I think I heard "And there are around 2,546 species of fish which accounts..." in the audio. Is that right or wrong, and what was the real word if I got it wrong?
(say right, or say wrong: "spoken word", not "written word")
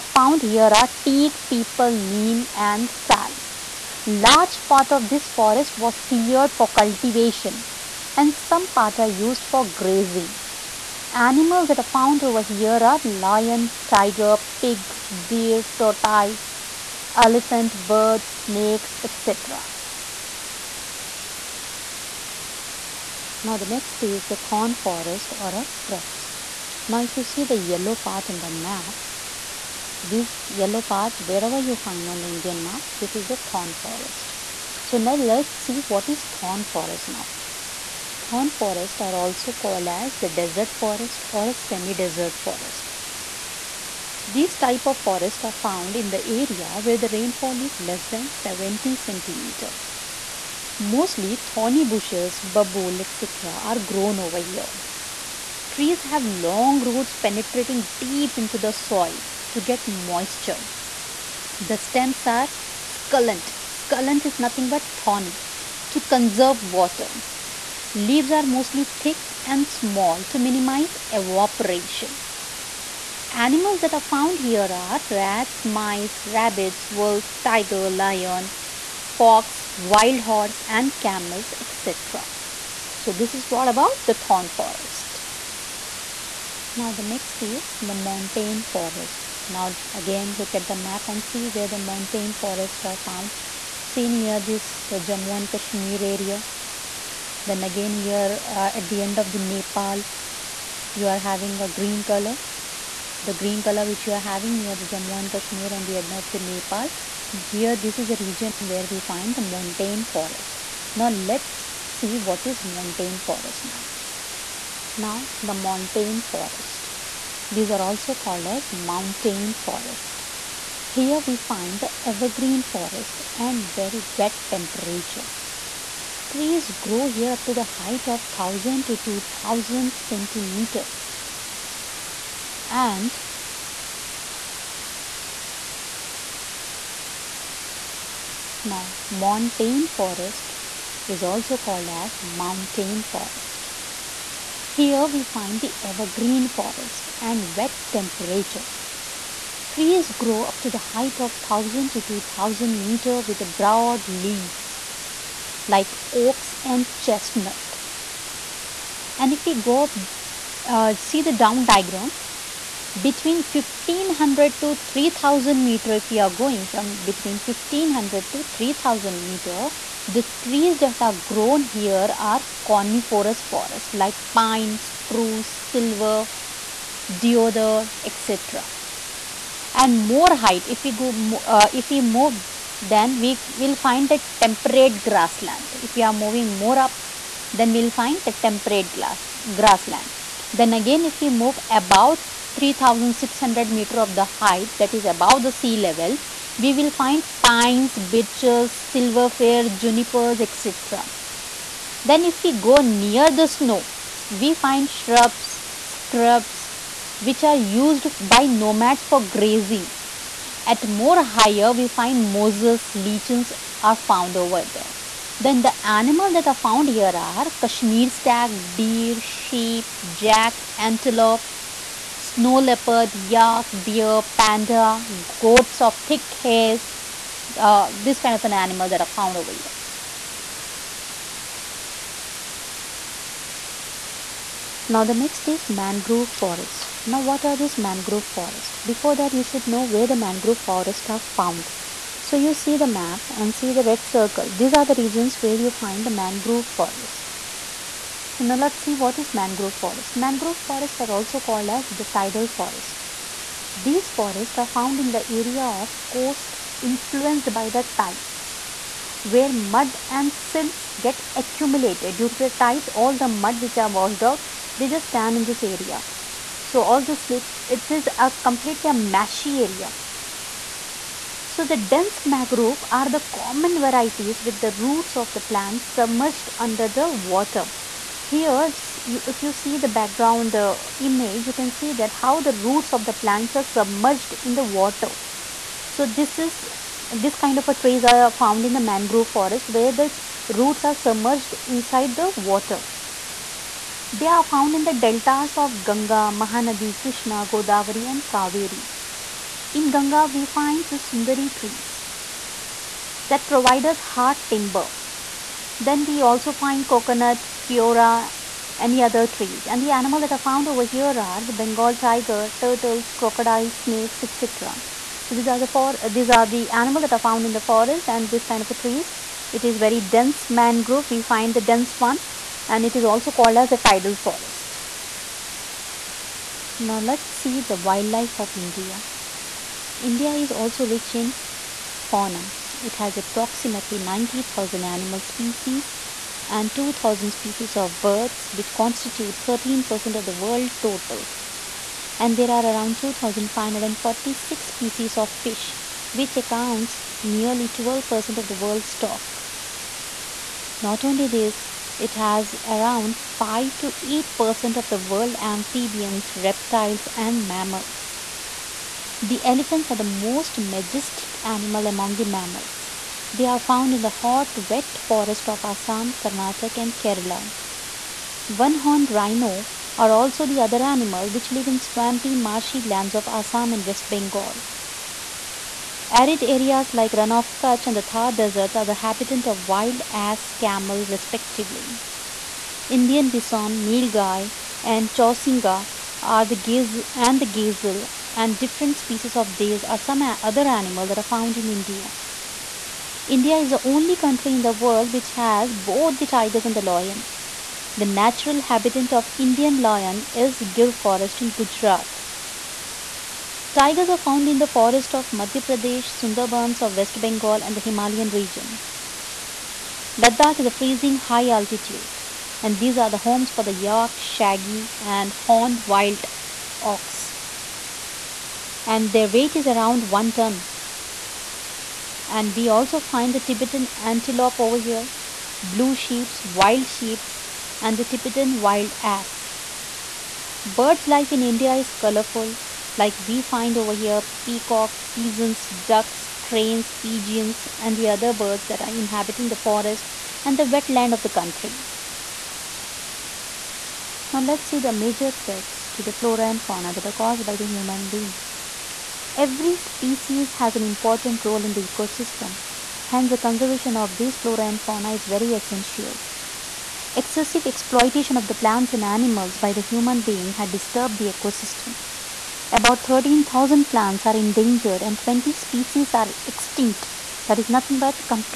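right.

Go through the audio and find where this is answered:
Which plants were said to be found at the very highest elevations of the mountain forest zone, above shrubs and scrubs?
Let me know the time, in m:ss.
3:32.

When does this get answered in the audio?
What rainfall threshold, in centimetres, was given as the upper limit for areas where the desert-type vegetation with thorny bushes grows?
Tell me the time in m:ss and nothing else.
0:48.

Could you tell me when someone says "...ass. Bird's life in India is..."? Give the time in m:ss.
7:09.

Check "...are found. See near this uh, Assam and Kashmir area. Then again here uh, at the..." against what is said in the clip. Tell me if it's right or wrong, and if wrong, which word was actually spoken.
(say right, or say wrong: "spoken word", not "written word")
wrong: "Jammu", not "Assam".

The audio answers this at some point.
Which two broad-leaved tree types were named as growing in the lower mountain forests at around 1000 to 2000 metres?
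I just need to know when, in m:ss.
2:36.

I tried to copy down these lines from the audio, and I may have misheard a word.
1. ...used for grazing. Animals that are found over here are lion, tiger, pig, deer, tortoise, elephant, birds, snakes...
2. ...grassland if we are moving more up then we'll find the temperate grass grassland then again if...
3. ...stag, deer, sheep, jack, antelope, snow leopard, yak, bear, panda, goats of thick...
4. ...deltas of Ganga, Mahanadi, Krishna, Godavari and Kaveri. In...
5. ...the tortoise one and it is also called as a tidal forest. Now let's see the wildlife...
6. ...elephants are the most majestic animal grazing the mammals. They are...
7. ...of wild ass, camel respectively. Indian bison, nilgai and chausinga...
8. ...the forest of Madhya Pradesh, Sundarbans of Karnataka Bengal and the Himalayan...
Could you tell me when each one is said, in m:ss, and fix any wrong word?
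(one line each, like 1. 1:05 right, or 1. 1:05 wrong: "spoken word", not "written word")
1. 0:09 right
2. 3:05 right
3. 3:38 right
4. 4:54 right
5. 5:21 wrong: "dense", not "tortoise"
6. 5:59 wrong: "among", not "grazing"
7. 6:19 right
8. 6:44 wrong: "West", not "Karnataka".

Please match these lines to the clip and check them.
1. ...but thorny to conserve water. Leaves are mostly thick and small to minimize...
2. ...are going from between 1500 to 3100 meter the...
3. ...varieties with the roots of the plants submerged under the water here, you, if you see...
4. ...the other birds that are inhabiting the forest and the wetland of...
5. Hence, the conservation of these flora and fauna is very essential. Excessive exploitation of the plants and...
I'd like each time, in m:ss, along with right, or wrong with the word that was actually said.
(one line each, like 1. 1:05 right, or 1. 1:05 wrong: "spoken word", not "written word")
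1. 1:04 right
2. 2:46 wrong: "3000", not "3100"
3. 4:33 right
4. 7:17 right
5. 7:33 right.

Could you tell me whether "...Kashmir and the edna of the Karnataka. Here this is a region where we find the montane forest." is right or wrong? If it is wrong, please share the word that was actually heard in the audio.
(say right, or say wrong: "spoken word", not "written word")
wrong: "Nepal", not "Karnataka".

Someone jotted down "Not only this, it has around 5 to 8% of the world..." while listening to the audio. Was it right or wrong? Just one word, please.
right.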